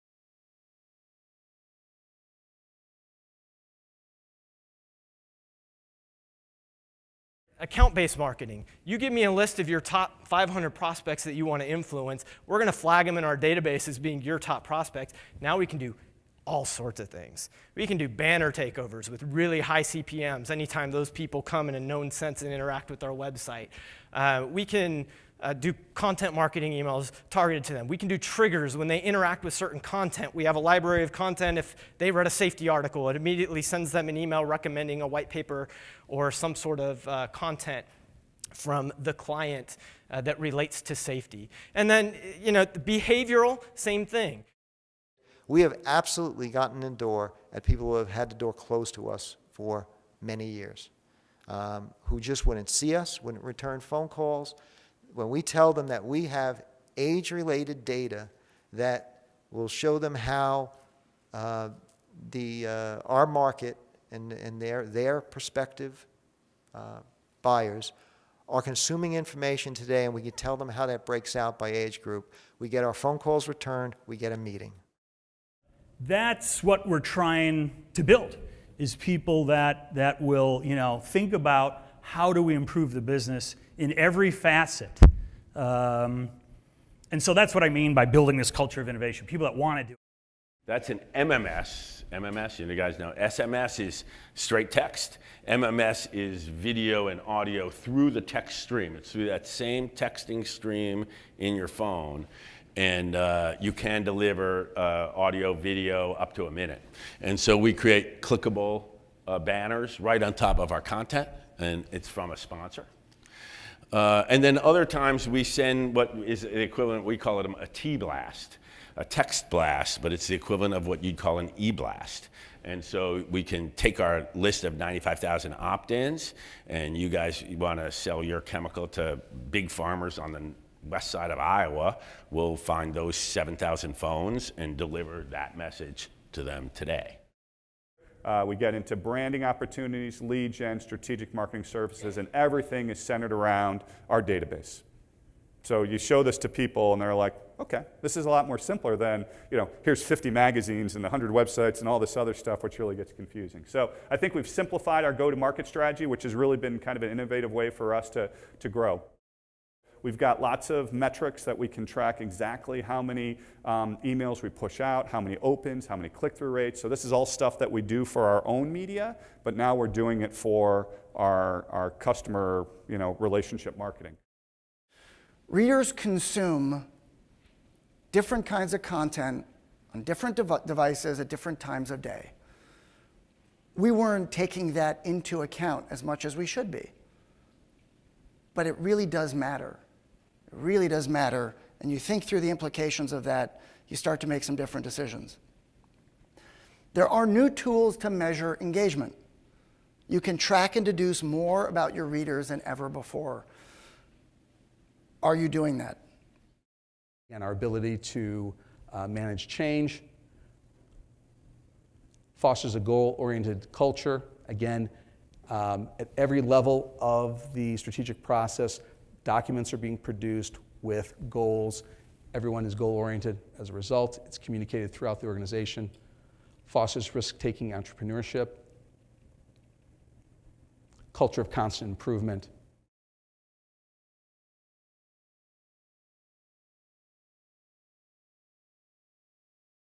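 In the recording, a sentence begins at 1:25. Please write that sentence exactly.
Um, and so that's what I mean by building this culture of innovation people that want to do it.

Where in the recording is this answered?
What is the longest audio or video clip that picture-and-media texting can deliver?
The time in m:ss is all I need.
1:46.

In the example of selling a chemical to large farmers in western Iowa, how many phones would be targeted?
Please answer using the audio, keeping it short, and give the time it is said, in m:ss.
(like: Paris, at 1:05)
7,000, at 2:13.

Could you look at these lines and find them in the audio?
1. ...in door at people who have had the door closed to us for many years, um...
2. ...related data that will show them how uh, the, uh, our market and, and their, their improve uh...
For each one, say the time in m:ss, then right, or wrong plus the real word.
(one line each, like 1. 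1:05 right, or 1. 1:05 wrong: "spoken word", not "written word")
1. 0:46 right
2. 0:57 wrong: "prospective", not "improve".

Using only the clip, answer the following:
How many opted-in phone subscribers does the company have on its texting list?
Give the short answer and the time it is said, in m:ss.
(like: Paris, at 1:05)
95,000, at 2:04.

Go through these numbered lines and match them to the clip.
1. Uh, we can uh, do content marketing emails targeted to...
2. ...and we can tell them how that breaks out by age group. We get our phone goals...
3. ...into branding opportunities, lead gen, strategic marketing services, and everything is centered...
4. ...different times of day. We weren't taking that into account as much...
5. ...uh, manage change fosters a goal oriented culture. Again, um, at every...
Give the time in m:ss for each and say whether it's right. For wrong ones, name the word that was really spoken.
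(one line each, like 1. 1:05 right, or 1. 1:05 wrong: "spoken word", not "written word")
1. 0:24 right
2. 1:10 wrong: "calls", not "goals"
3. 2:18 right
4. 3:01 right
5. 3:28 right.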